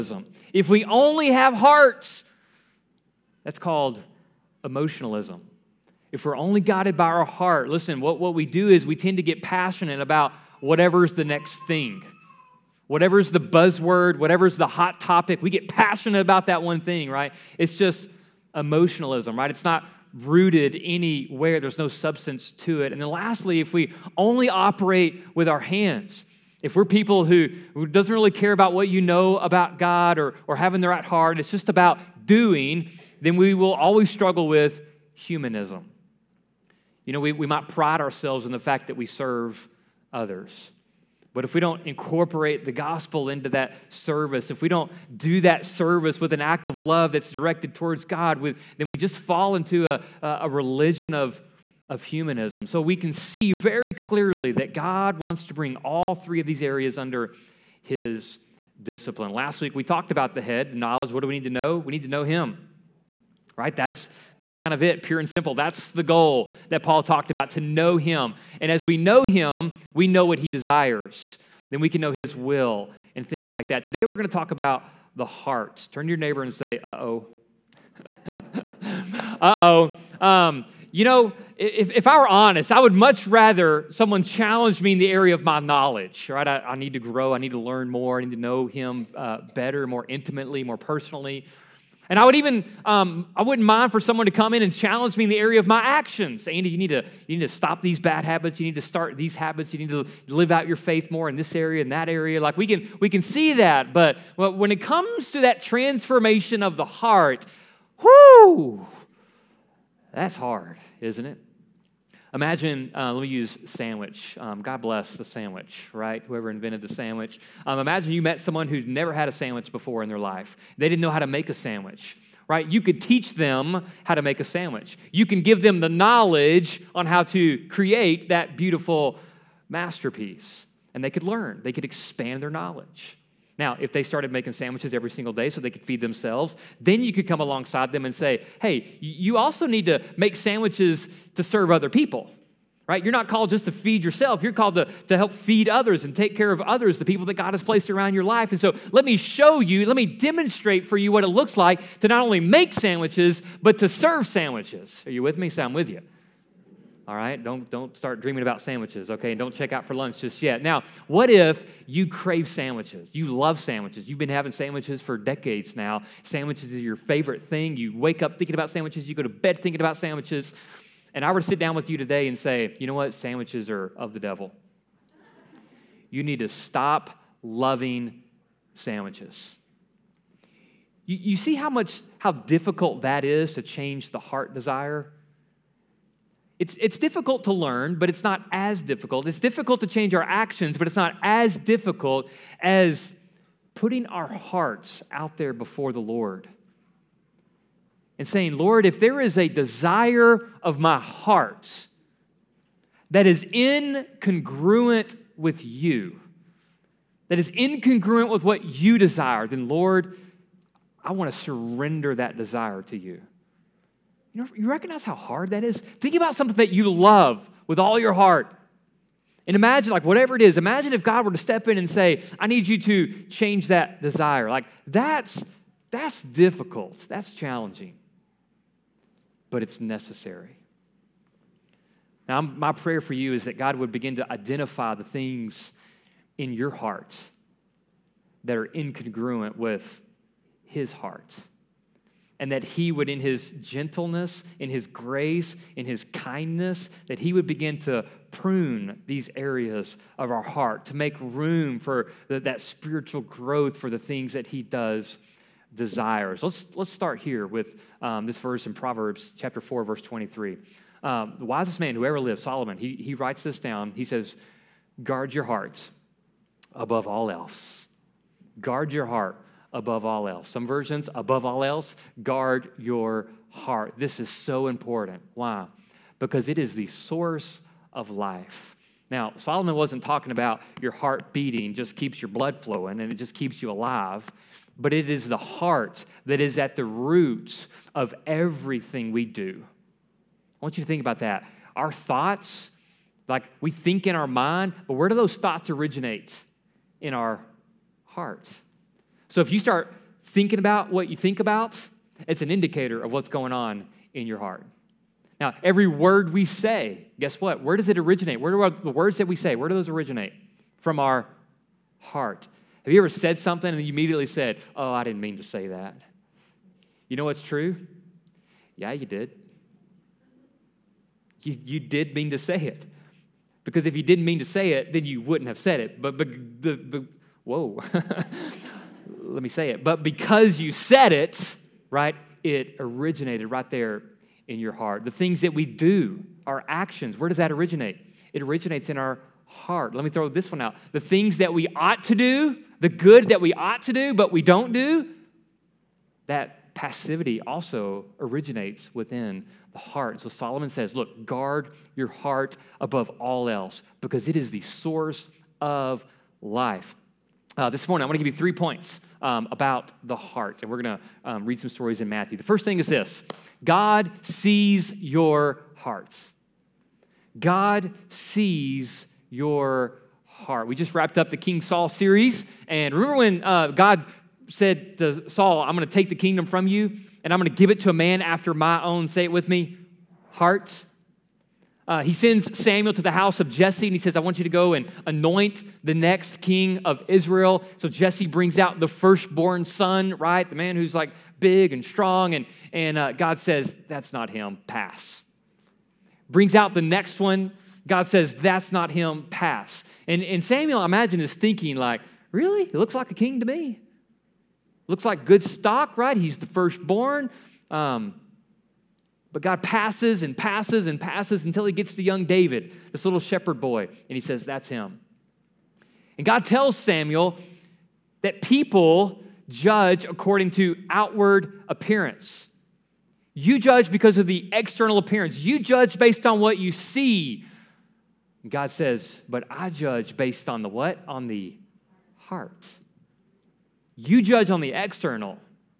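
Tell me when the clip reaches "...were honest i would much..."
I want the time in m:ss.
1:22.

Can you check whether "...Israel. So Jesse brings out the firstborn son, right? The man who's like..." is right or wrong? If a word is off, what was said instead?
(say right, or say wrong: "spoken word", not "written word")
right.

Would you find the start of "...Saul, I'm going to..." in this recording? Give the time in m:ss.
6:15.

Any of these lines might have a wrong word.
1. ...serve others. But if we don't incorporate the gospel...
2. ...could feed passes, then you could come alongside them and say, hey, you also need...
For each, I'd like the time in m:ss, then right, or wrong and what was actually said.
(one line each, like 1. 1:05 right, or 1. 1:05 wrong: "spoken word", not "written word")
1. 0:39 right
2. 2:15 wrong: "themselves", not "passes".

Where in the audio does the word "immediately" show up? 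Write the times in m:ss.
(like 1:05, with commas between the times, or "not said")
5:13.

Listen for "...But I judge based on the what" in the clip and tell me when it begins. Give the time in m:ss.
7:09.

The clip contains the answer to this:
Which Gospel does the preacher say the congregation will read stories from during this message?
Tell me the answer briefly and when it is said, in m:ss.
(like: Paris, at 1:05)
Matthew, at 6:02.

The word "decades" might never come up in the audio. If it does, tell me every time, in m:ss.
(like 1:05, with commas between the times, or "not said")
2:45.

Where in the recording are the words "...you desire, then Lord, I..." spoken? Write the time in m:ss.
3:28.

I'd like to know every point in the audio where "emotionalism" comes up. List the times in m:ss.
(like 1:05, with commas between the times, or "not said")
0:04, 0:18.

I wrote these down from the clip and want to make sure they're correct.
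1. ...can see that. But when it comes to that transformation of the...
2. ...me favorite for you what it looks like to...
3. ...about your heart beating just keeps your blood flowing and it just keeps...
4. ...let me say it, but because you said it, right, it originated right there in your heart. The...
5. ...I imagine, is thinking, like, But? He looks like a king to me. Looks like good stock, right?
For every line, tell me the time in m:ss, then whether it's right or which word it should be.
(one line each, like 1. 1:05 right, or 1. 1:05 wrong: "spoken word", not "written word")
1. 1:43 right
2. 2:29 wrong: "demonstrate", not "favorite"
3. 4:40 right
4. 5:29 right
5. 6:40 wrong: "Really", not "But".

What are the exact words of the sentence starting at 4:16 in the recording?
Let's, let's start here with um, this verse in Proverbs chapter 4, verse 23.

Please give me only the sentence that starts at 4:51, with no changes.
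Our thoughts, like we think in our mind, but where do those thoughts originate?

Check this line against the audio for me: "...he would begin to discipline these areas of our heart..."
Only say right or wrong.
wrong.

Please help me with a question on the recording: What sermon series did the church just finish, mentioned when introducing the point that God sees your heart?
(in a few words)
King Saul series.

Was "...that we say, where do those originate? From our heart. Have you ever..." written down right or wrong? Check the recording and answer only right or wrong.
right.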